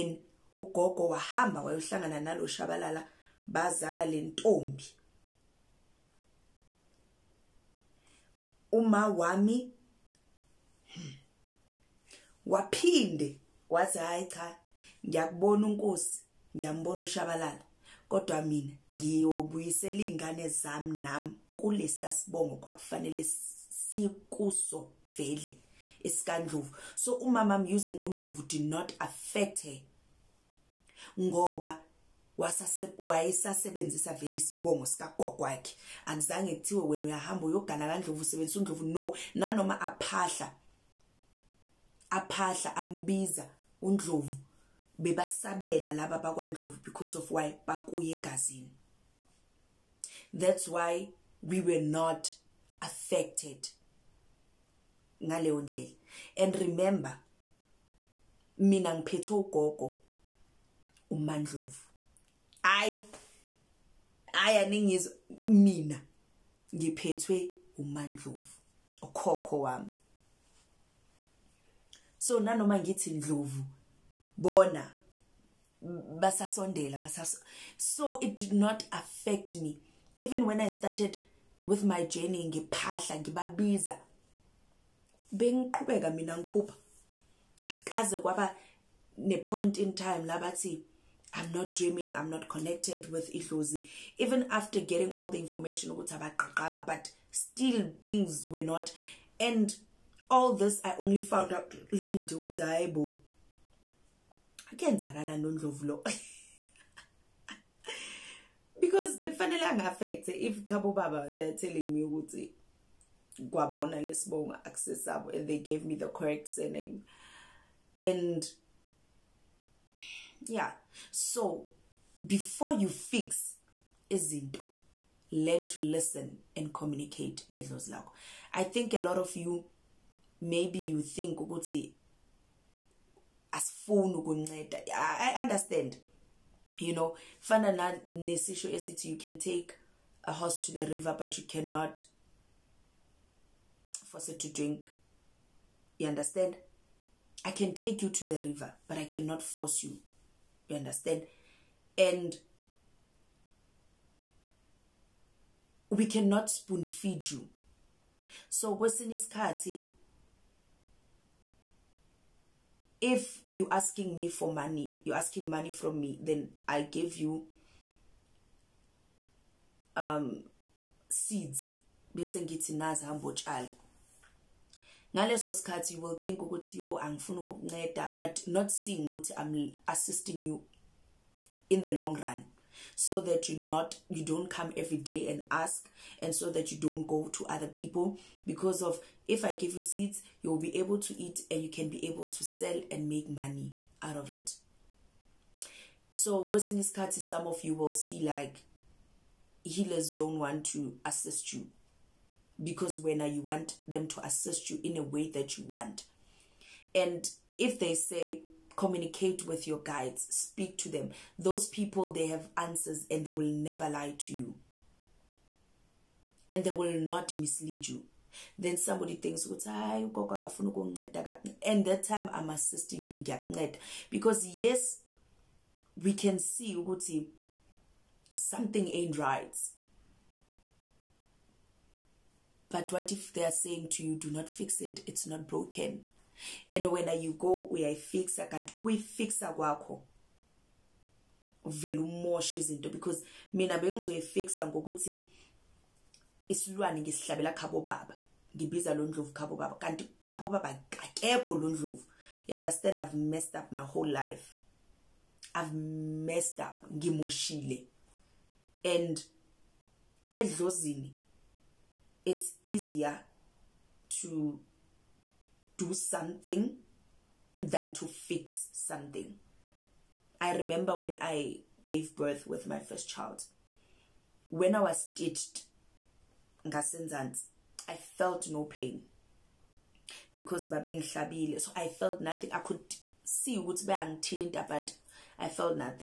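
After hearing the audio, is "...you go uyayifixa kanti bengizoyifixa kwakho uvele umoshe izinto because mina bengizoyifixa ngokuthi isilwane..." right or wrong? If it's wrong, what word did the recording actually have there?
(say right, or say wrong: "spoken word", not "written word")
wrong: "ukuyifixa", not "bengizoyifixa".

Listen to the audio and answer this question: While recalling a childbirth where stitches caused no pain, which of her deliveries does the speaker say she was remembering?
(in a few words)
first child.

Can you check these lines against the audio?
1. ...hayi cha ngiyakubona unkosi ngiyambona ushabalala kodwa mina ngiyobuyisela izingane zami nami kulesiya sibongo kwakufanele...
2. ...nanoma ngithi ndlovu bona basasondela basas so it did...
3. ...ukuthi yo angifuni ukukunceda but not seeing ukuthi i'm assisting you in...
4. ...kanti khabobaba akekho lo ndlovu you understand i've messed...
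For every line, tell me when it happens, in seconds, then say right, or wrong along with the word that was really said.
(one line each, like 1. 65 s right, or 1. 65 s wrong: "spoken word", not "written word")
1. 13 s right
2. 72 s right
3. 176 s right
4. 249 s right.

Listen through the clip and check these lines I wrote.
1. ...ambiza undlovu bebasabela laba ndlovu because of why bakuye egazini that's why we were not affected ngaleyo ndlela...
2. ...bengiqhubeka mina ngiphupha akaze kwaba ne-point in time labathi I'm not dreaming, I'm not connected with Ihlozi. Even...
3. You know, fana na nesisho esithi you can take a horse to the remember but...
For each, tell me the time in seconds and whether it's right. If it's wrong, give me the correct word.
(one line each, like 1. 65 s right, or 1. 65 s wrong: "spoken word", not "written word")
1. 42 s wrong: "bakwandlovu", not "ndlovu"
2. 85 s right
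3. 136 s wrong: "river", not "remember".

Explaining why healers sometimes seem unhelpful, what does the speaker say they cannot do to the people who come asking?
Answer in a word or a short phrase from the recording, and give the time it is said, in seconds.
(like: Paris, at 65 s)
spoon feed, at 156 s.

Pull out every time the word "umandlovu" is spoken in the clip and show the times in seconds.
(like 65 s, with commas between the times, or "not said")
61 s, 67 s.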